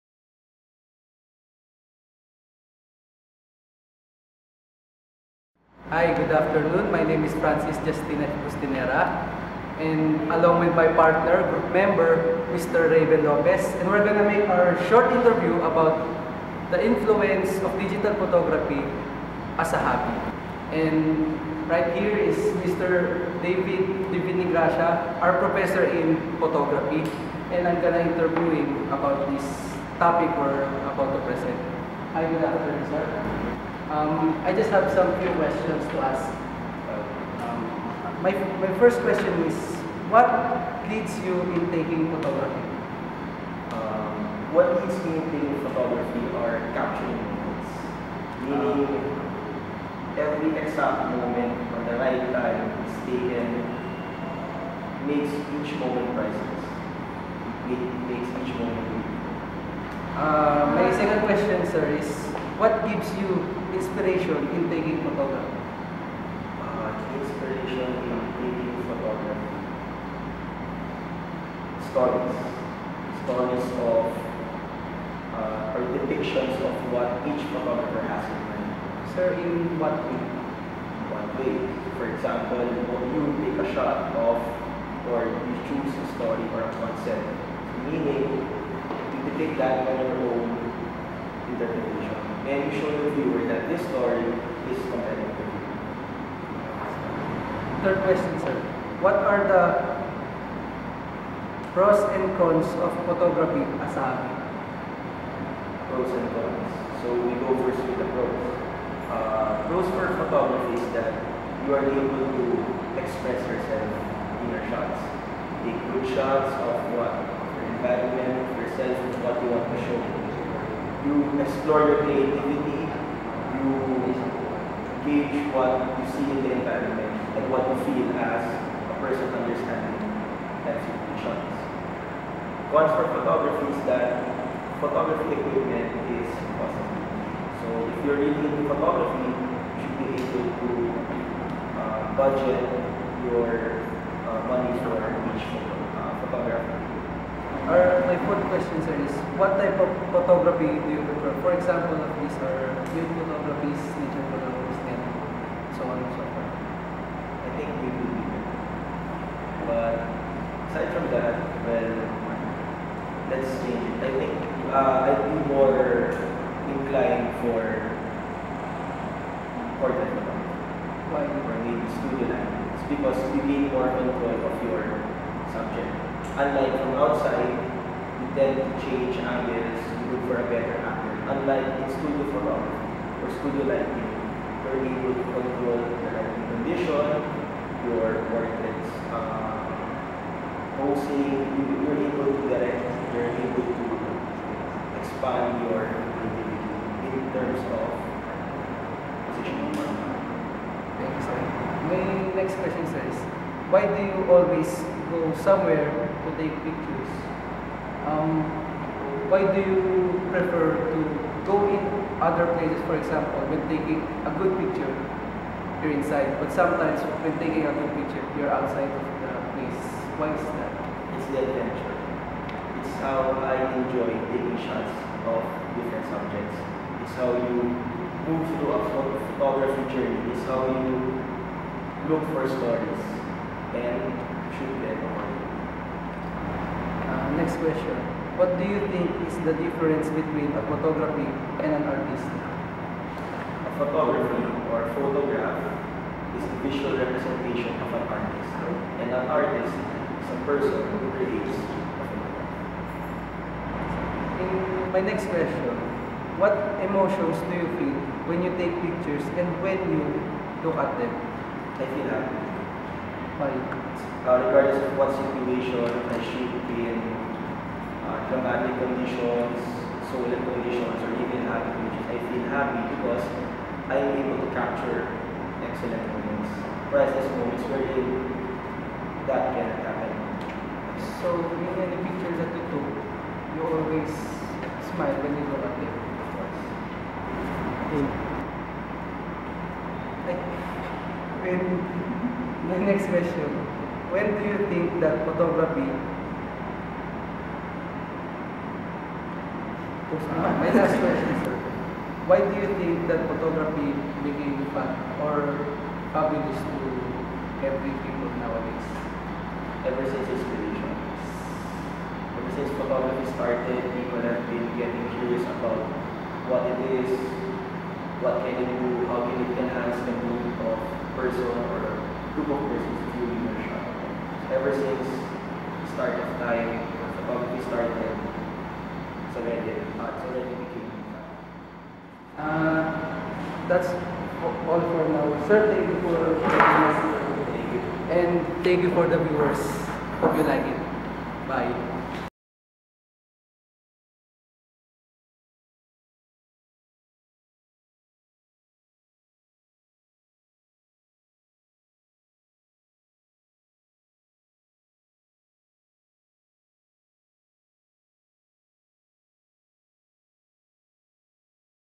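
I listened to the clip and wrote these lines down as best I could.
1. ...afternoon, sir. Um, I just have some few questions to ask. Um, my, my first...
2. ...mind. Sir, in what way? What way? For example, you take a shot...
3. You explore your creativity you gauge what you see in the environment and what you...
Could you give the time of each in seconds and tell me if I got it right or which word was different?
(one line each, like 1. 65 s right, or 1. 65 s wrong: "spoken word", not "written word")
1. 32 s right
2. 78 s right
3. 121 s right.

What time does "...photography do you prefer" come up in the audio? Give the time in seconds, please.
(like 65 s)
150 s.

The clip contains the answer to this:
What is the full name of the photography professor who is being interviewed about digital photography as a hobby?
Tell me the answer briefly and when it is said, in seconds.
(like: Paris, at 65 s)
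David Divinigracia, at 22 s.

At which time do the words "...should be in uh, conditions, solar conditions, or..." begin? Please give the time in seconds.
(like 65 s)
266 s.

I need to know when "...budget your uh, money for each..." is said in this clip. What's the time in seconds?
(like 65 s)
142 s.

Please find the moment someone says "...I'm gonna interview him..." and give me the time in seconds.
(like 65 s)
27 s.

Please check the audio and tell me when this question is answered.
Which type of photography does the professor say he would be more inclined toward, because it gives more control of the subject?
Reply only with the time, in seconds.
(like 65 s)
169 s.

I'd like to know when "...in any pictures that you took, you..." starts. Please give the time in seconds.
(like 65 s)
281 s.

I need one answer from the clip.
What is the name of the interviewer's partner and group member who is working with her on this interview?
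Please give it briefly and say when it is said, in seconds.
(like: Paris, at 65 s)
Raven Lopez, at 12 s.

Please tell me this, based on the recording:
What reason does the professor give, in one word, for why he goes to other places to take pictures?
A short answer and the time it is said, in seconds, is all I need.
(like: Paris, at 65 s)
Adventure, at 221 s.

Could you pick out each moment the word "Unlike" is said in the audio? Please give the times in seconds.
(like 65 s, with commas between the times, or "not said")
176 s, 181 s.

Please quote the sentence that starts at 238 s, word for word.
What do you think is the difference between a photography and an artist?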